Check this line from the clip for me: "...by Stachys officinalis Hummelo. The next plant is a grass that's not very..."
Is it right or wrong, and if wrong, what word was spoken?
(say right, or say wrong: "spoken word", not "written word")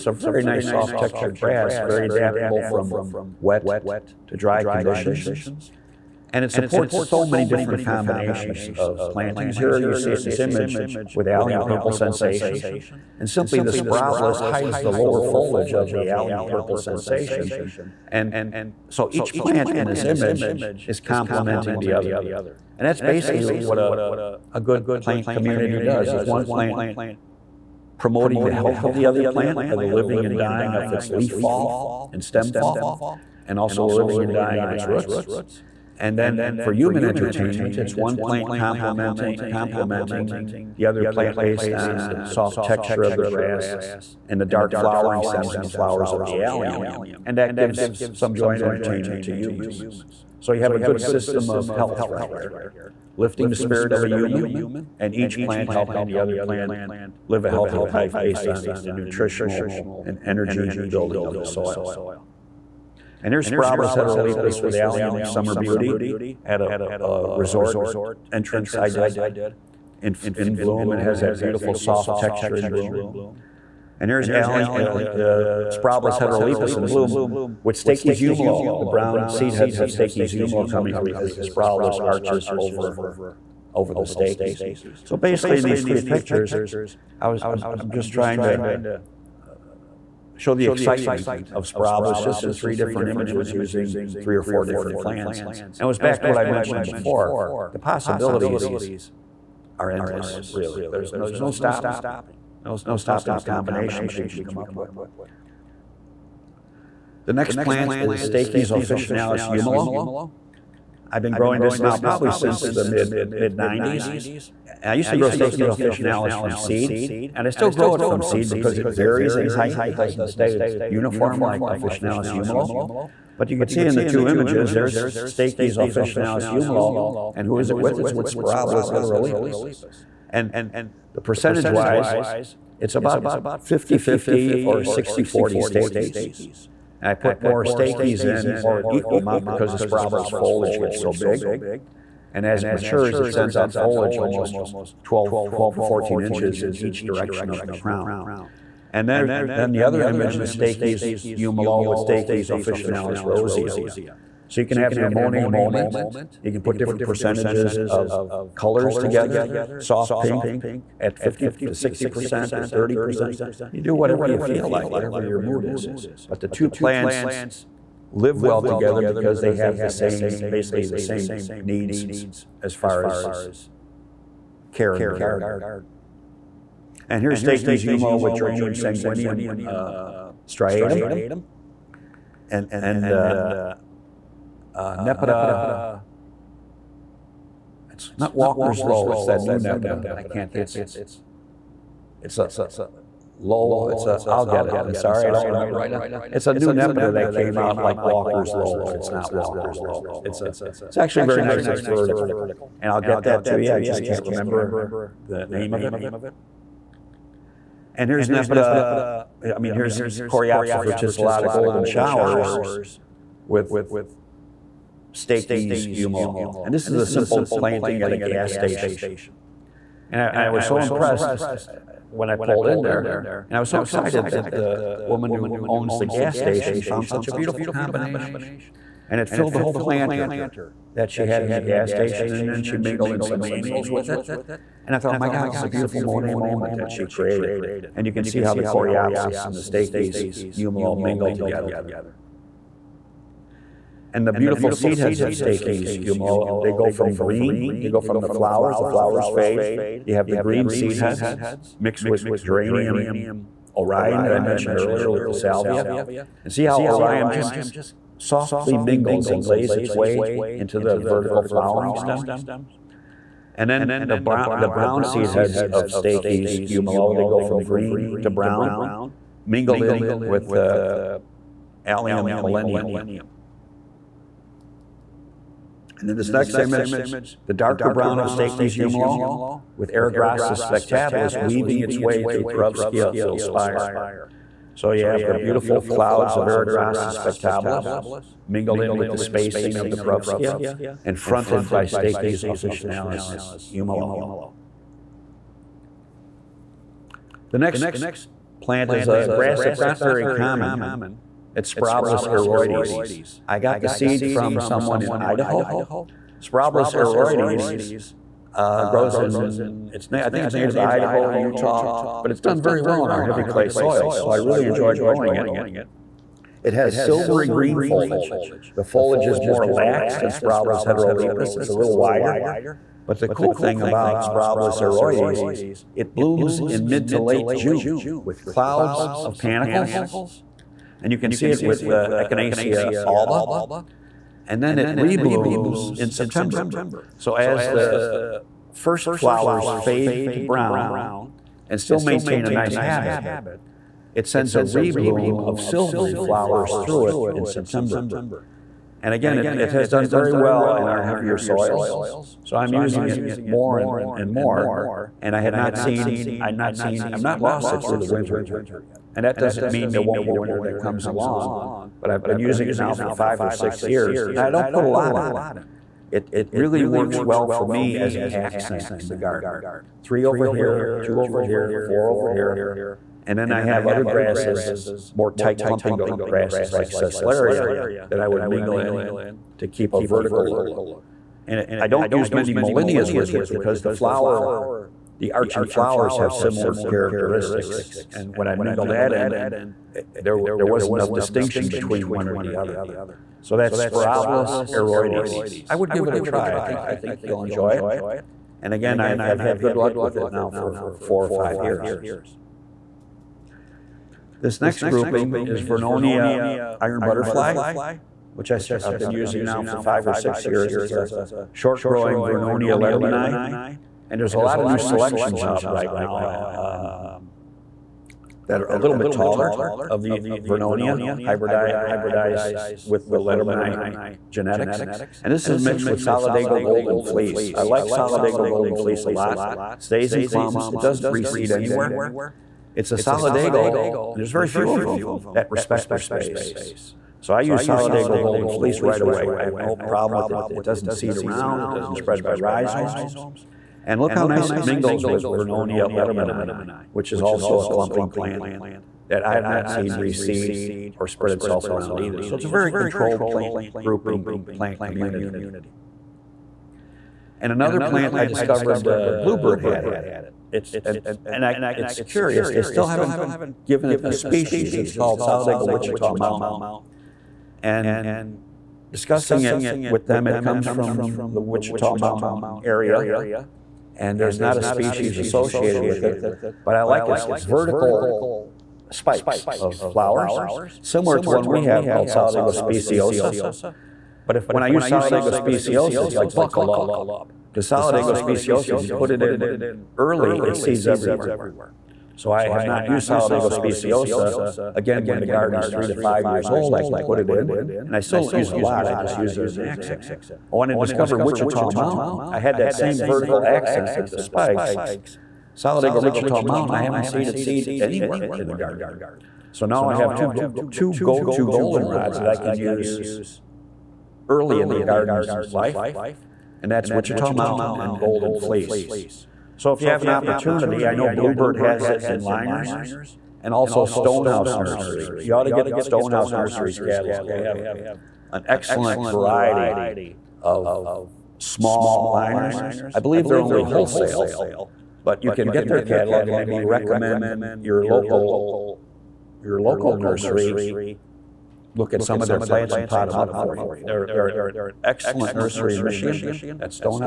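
right.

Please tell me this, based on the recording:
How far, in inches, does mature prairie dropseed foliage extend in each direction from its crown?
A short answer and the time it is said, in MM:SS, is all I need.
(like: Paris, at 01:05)
12 to 14 inches, at 02:25.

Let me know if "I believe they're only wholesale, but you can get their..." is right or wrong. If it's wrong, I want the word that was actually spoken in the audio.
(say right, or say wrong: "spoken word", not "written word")
right.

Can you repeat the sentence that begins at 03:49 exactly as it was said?
And it filled the whole planter that she had in the gas station, and then she mingled in some annuals with it.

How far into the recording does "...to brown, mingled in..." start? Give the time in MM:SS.
04:28.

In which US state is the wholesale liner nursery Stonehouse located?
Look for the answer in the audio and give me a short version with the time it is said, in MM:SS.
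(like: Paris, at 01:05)
Michigan, at 09:05.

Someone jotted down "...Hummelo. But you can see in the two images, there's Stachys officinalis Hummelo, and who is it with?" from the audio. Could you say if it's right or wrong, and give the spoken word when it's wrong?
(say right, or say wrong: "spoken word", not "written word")
right.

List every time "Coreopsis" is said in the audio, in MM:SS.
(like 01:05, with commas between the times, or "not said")
03:30, 03:58.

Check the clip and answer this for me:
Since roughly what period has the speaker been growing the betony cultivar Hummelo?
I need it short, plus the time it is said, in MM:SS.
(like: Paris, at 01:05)
mid 90s, at 01:52.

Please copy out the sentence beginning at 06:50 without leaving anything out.
It's a short growing Vernonia lettermannii.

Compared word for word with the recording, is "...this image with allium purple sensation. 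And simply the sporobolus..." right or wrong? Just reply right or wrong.
right.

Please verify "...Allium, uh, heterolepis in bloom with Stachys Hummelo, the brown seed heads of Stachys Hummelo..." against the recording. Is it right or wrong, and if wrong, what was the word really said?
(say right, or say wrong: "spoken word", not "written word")
right.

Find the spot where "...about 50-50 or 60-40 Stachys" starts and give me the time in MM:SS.
02:12.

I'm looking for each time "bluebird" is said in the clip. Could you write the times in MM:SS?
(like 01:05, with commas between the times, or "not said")
07:39, 08:41.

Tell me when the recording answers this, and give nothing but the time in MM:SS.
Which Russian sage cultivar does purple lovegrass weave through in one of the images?
04:42.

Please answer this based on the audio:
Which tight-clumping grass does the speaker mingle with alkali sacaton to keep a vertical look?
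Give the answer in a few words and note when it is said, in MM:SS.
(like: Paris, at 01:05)
Sesleria, at 06:16.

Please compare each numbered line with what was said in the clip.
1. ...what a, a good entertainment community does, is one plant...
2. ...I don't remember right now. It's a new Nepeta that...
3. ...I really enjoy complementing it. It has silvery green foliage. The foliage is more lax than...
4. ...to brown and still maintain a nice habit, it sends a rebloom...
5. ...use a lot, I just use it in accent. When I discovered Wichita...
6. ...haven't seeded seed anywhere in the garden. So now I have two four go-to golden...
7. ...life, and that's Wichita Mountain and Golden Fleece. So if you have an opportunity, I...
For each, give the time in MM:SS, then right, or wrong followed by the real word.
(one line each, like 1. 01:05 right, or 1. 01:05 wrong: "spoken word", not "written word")
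1. 00:23 wrong: "plant", not "entertainment"
2. 03:15 right
3. 05:14 wrong: "growing", not "complementing"
4. 05:40 right
5. 08:18 right
6. 08:26 wrong: "two", not "four"
7. 08:35 right.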